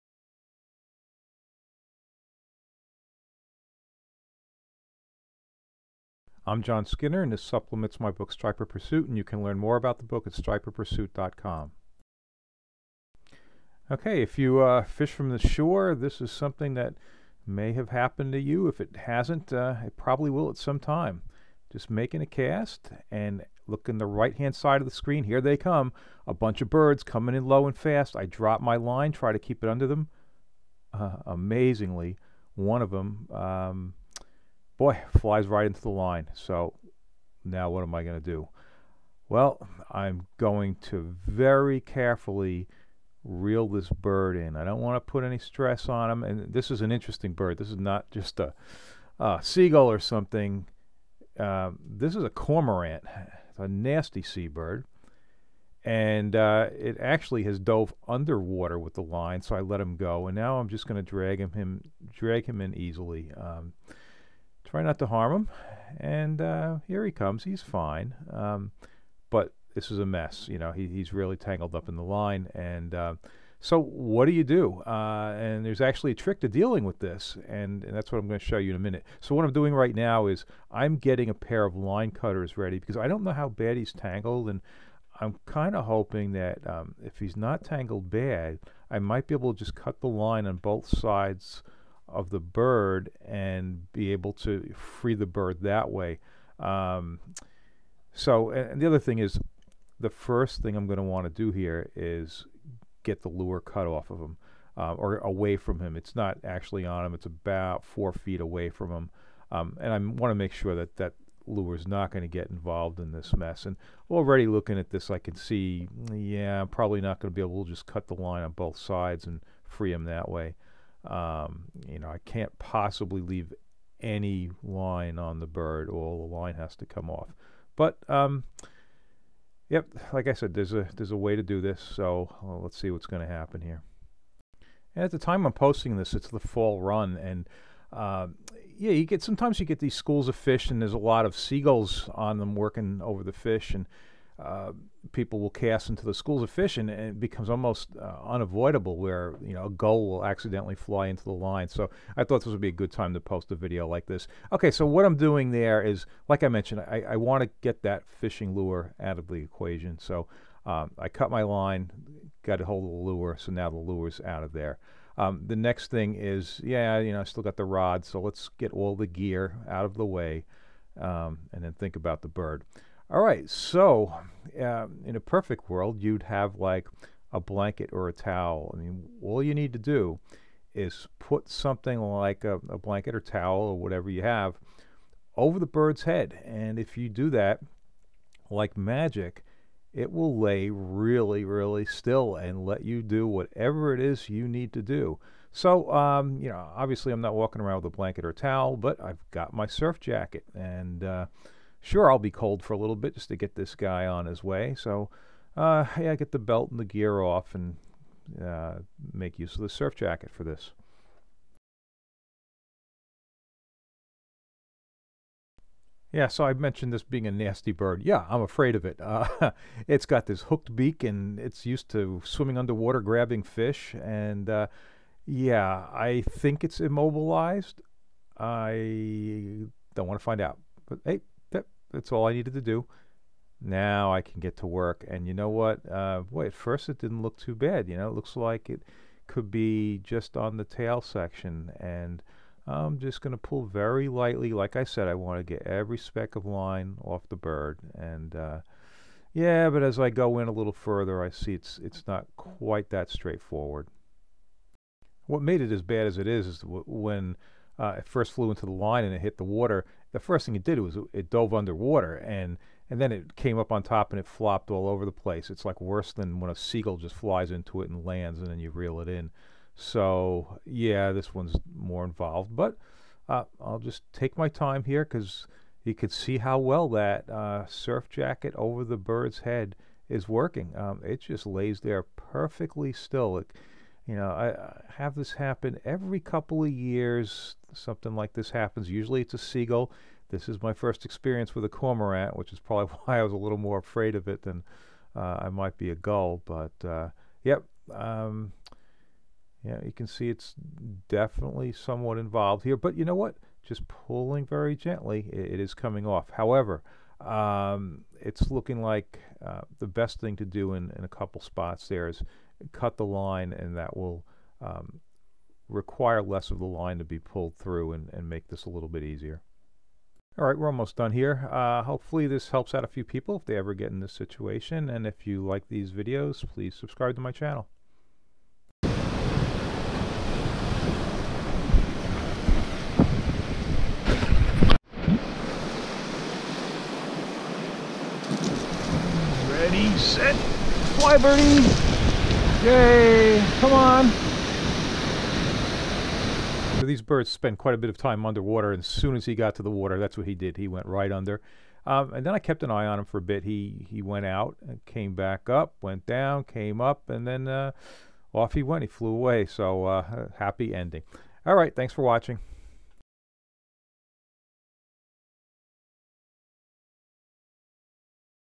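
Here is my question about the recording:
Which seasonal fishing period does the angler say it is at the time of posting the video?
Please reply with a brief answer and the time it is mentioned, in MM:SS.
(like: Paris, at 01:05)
The fall run, at 02:16.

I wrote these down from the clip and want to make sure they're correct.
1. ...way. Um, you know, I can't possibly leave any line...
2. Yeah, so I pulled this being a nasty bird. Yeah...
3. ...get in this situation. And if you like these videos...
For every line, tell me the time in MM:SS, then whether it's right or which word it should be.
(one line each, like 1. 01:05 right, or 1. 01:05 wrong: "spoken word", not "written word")
1. 02:00 right
2. 03:36 wrong: "mentioned", not "pulled"
3. 05:23 right.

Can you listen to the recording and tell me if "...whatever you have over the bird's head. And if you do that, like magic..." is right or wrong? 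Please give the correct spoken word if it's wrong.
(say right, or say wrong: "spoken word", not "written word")
right.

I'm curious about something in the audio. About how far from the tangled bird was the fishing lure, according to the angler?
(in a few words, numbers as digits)
4 feet.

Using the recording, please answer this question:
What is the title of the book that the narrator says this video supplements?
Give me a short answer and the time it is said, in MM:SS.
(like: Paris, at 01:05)
Striper Pursuit, at 00:08.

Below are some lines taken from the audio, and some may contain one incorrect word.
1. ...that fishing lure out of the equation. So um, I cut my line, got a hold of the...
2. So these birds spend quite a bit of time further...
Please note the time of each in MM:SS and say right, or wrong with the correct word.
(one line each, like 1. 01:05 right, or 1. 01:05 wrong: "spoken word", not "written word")
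1. 02:37 right
2. 05:46 wrong: "underwater", not "further".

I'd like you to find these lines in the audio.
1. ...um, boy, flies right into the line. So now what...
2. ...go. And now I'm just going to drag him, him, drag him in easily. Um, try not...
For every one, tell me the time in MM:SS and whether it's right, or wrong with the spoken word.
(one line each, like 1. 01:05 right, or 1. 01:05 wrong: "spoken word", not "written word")
1. 00:33 right
2. 00:59 right.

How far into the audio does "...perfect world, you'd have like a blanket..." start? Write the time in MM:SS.
02:55.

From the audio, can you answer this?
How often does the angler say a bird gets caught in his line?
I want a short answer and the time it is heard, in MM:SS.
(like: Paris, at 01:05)
Every couple of years, at 04:45.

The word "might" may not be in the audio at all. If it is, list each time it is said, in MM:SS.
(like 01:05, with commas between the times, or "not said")
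01:28, 04:55.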